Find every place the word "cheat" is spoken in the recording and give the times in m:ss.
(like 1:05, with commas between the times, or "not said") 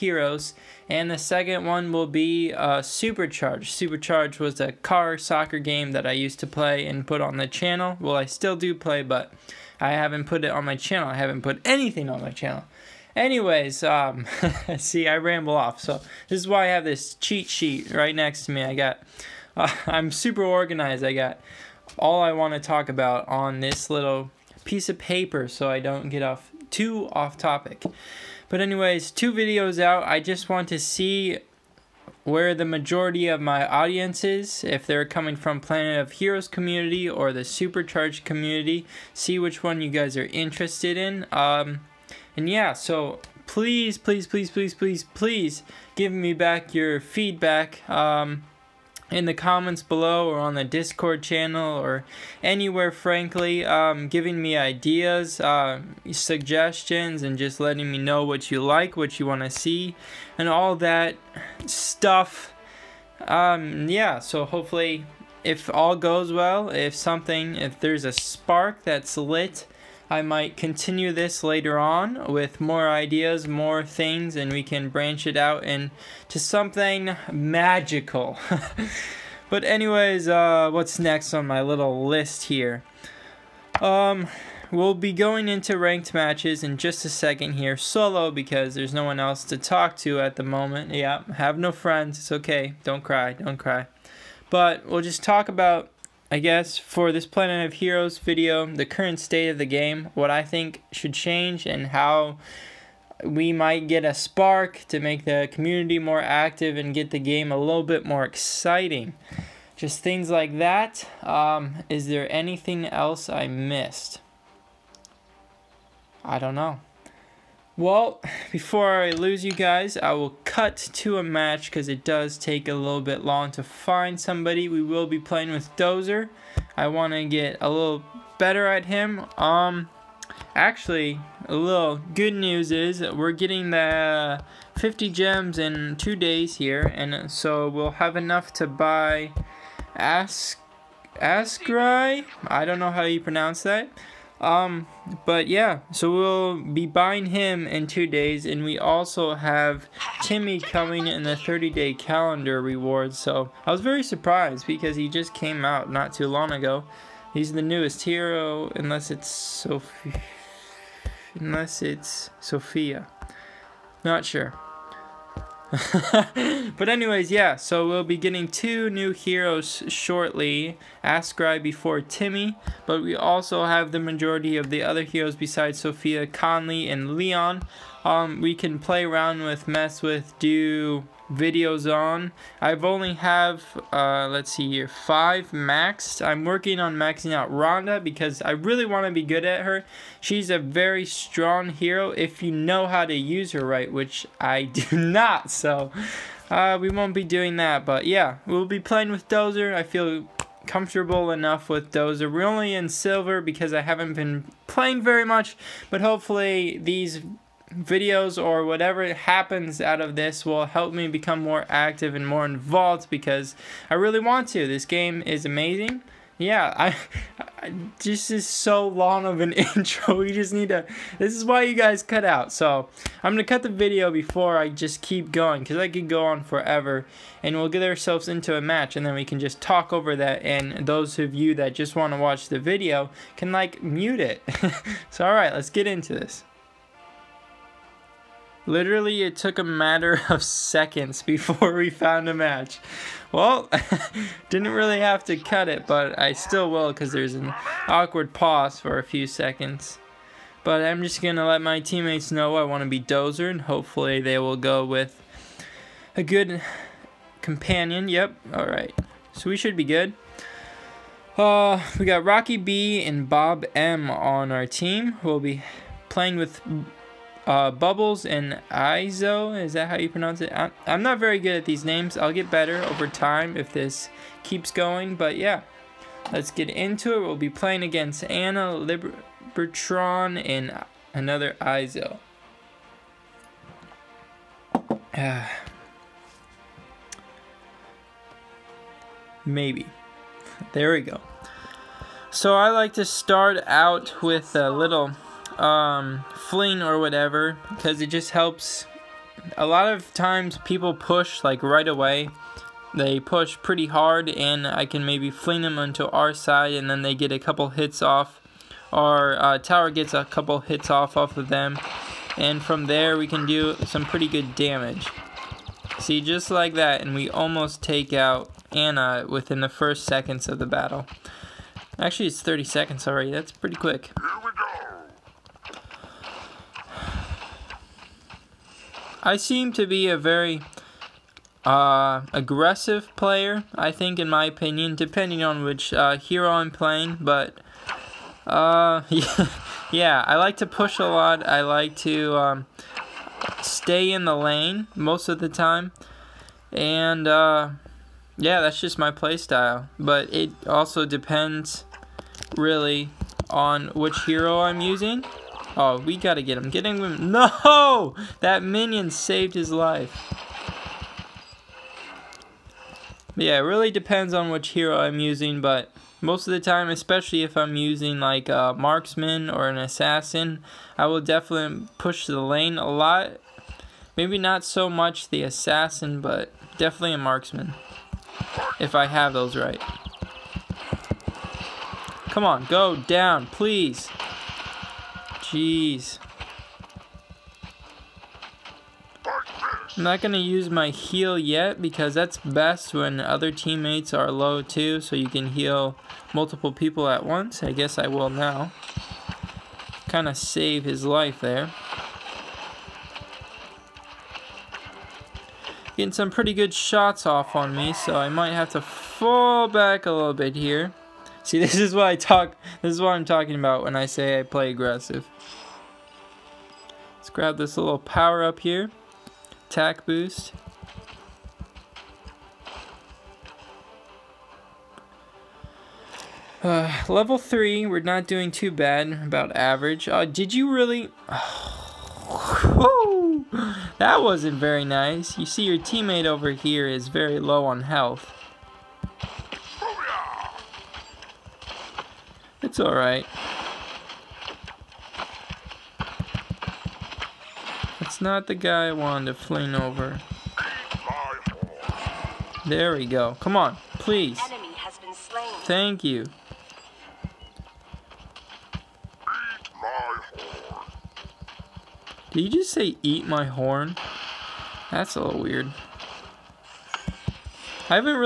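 0:17.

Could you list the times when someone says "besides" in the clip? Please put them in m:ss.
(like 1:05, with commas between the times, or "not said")
2:55.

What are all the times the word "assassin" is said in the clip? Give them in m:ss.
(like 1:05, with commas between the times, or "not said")
6:09, 6:15.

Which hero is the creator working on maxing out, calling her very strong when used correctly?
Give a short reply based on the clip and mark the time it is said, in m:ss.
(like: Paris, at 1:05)
Rhonda, at 3:07.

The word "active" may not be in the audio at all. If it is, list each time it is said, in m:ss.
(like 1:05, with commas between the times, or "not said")
1:46, 3:31.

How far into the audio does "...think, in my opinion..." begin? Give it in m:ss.
5:33.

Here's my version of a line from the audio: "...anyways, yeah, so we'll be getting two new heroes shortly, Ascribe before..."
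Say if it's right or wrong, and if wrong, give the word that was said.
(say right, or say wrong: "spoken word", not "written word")
right.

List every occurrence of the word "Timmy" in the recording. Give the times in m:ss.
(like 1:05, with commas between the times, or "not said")
2:30, 2:51.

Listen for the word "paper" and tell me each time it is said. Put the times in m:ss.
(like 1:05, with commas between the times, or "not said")
0:24.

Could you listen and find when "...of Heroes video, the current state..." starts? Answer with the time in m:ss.
1:37.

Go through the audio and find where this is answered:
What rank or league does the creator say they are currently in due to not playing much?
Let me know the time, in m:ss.
3:22.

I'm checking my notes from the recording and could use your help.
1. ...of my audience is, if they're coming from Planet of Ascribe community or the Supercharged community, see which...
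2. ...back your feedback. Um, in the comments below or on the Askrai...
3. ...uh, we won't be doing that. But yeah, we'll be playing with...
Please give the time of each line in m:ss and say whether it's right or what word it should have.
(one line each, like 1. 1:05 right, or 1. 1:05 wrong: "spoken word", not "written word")
1. 0:33 wrong: "Heroes", not "Ascribe"
2. 0:46 wrong: "Discord", not "Askrai"
3. 3:16 right.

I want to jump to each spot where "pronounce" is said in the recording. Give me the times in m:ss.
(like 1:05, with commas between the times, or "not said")
2:23, 4:30.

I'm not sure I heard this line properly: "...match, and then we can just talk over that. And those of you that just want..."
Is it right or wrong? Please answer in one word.
right.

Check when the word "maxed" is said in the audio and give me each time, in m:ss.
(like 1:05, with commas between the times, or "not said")
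3:05.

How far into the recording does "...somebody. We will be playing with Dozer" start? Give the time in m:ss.
2:04.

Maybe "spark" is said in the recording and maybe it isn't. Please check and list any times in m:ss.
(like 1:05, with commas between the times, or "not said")
1:08, 1:44.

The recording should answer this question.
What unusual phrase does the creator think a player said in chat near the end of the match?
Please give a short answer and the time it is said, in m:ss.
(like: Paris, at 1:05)
Eat my horn, at 7:43.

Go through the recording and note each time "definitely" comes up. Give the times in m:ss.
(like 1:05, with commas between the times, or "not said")
6:11, 6:16.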